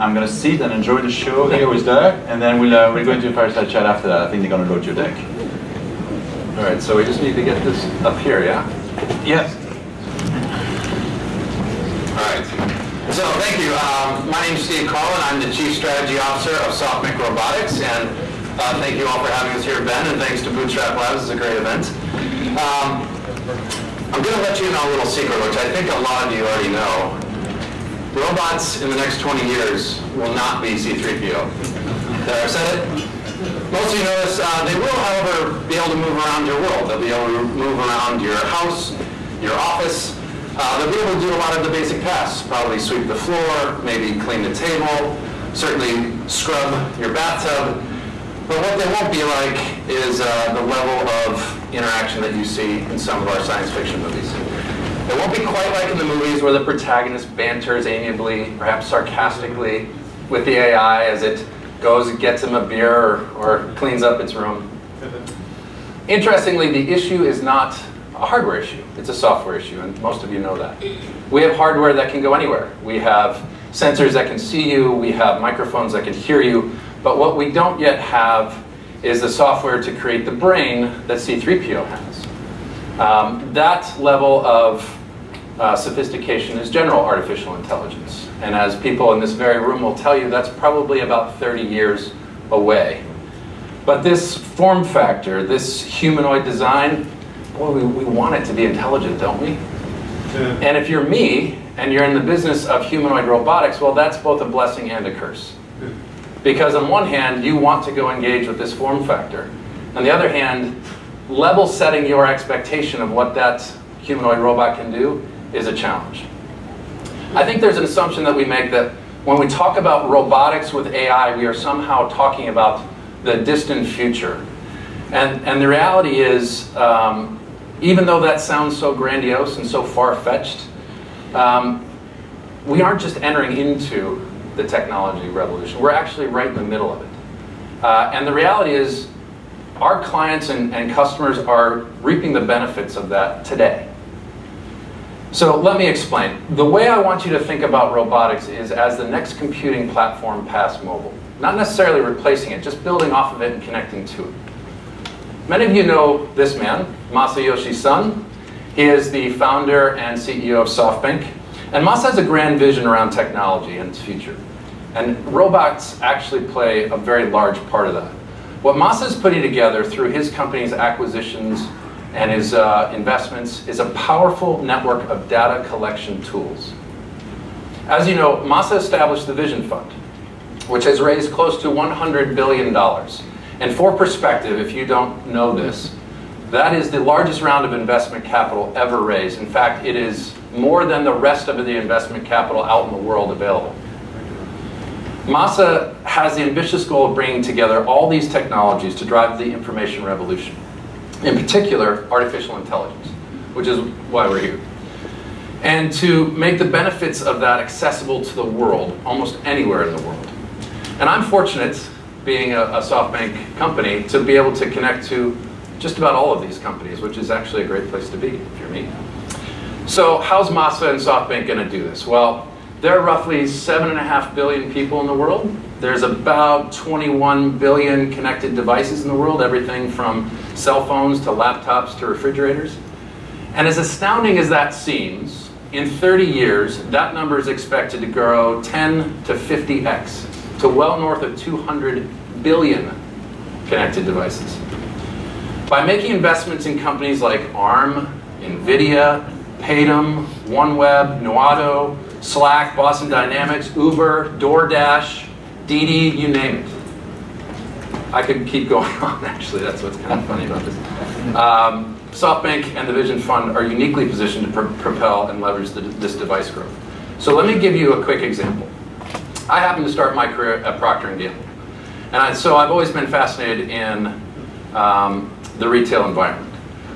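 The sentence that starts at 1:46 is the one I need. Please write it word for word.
Because on one hand, you want to go engage with this form factor.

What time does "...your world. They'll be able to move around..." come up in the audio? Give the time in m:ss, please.
0:36.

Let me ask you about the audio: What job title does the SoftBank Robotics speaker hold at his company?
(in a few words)
Chief Strategy Officer.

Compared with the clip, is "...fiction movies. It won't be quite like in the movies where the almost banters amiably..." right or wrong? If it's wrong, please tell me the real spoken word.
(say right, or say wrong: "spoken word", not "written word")
wrong: "protagonist", not "almost".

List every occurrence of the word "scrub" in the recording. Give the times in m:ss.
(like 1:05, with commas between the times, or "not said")
0:46.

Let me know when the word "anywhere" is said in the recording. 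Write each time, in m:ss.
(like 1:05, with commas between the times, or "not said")
1:12, 3:29.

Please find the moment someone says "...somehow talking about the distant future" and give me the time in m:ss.
2:01.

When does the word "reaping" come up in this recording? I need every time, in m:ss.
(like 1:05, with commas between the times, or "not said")
2:22.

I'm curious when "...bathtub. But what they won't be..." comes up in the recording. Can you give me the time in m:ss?
0:47.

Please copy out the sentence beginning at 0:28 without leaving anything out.
Robots in the next 20 years will not be C-3PO.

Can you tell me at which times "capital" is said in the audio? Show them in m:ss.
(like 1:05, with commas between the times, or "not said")
3:08, 3:12.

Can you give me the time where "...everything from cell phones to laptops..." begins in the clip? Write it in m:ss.
3:49.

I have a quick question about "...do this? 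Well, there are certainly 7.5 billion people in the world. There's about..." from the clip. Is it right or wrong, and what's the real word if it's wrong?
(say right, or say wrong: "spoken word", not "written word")
wrong: "roughly", not "certainly".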